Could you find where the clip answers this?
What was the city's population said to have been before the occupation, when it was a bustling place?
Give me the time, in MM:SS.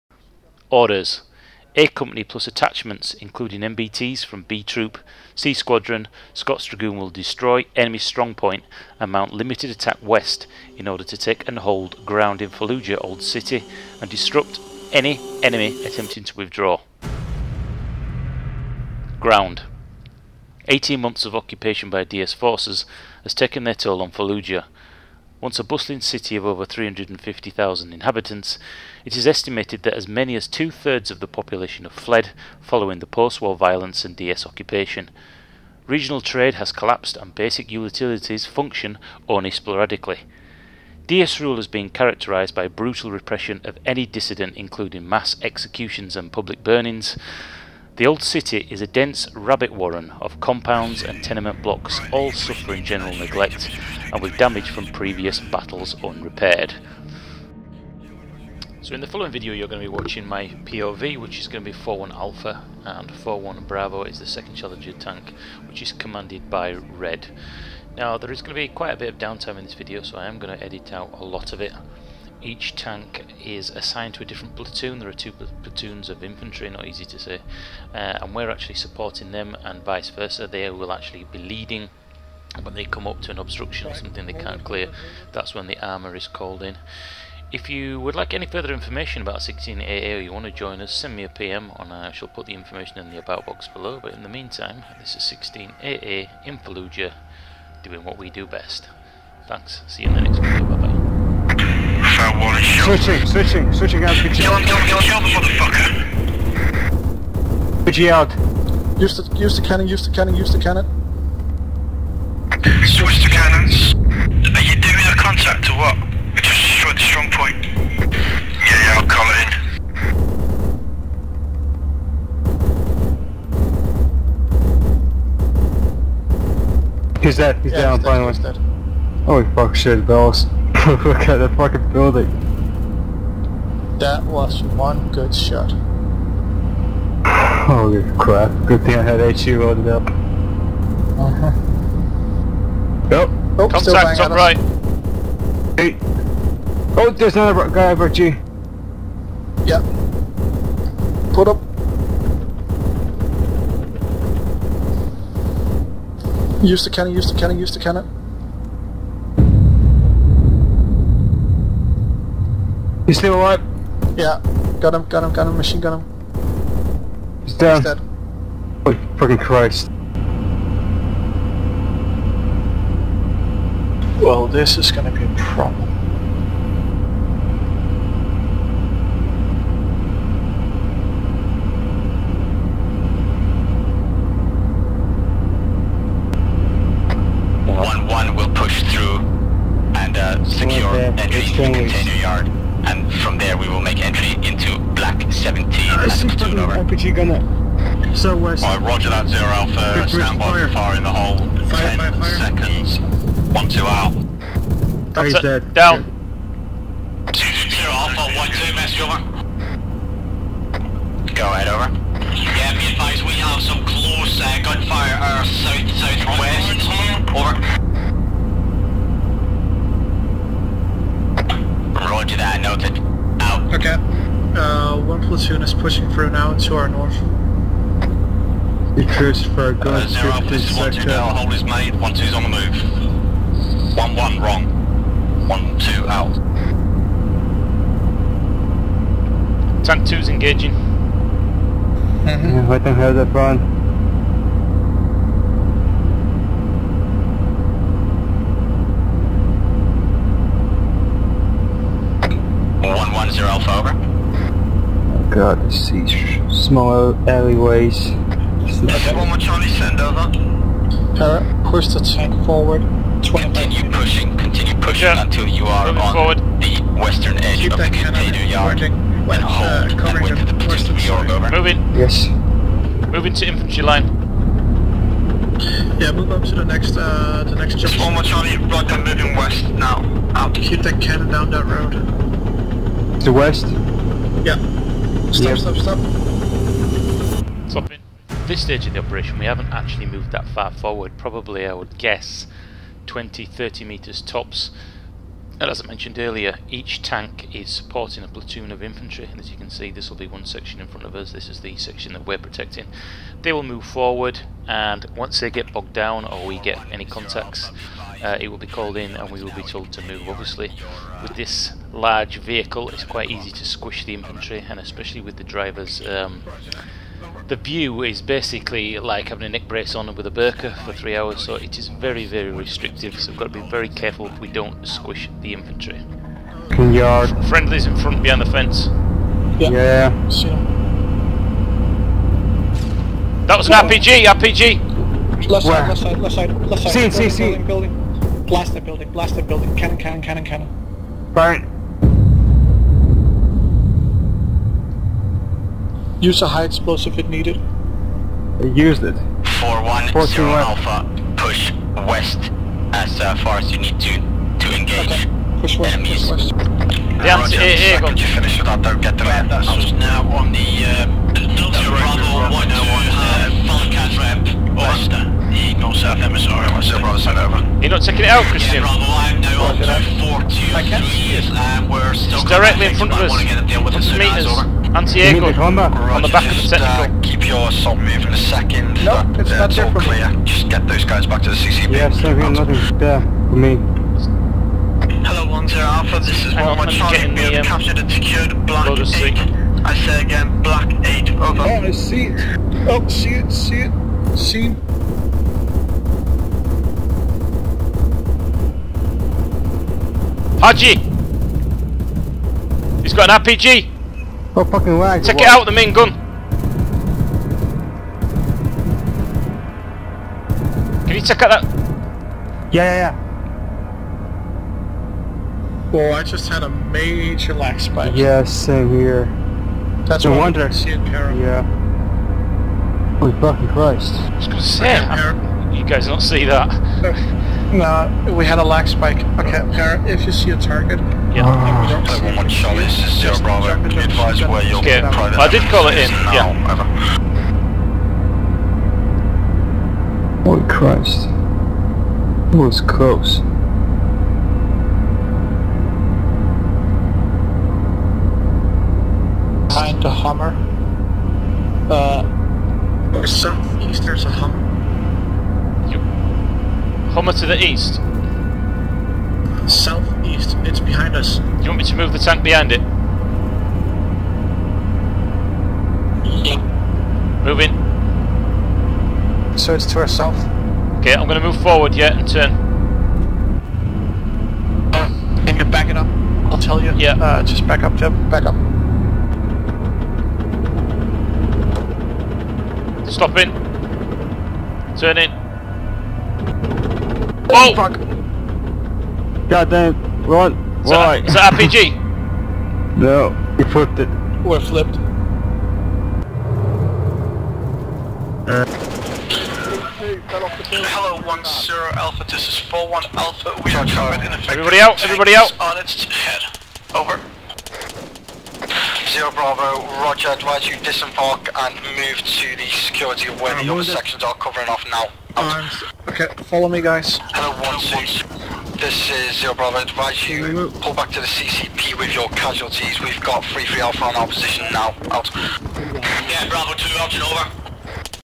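00:26.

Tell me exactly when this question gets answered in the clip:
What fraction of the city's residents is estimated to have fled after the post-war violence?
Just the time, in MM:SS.
00:30.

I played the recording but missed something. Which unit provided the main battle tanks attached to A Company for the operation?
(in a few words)
B Troop, C Squadron, Scots Dragoon.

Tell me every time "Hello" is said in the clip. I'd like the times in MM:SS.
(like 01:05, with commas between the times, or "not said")
06:25, 08:20, 08:37.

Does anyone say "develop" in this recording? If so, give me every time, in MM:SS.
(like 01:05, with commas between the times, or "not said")
not said.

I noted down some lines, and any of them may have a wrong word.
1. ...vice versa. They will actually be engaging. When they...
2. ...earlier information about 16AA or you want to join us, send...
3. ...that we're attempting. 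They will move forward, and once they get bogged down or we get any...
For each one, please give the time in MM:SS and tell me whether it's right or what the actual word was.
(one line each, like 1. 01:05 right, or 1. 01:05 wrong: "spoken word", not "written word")
1. 01:19 wrong: "leading", not "engaging"
2. 01:28 wrong: "further", not "earlier"
3. 05:02 wrong: "protecting", not "attempting".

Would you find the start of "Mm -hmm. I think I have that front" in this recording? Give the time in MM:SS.
04:02.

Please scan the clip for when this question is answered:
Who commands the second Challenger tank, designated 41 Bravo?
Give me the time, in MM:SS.
01:06.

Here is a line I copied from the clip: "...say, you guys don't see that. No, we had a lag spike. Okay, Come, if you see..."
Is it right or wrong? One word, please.
wrong.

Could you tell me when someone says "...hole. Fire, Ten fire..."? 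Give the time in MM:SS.
03:21.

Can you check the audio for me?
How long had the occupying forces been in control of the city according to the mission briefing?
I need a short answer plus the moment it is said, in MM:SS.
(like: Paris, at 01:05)
18 months, at 00:20.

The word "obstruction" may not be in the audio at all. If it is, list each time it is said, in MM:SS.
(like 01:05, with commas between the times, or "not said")
01:23.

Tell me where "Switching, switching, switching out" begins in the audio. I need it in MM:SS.
01:42.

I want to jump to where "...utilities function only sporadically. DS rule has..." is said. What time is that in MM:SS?
00:37.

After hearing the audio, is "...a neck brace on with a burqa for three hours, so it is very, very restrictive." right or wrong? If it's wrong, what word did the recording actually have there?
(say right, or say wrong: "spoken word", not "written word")
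right.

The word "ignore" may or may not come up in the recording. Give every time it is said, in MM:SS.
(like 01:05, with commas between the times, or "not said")
not said.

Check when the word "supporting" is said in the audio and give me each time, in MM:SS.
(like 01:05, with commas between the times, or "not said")
01:18, 04:57.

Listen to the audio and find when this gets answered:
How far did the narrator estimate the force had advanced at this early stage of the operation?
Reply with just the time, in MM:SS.
04:53.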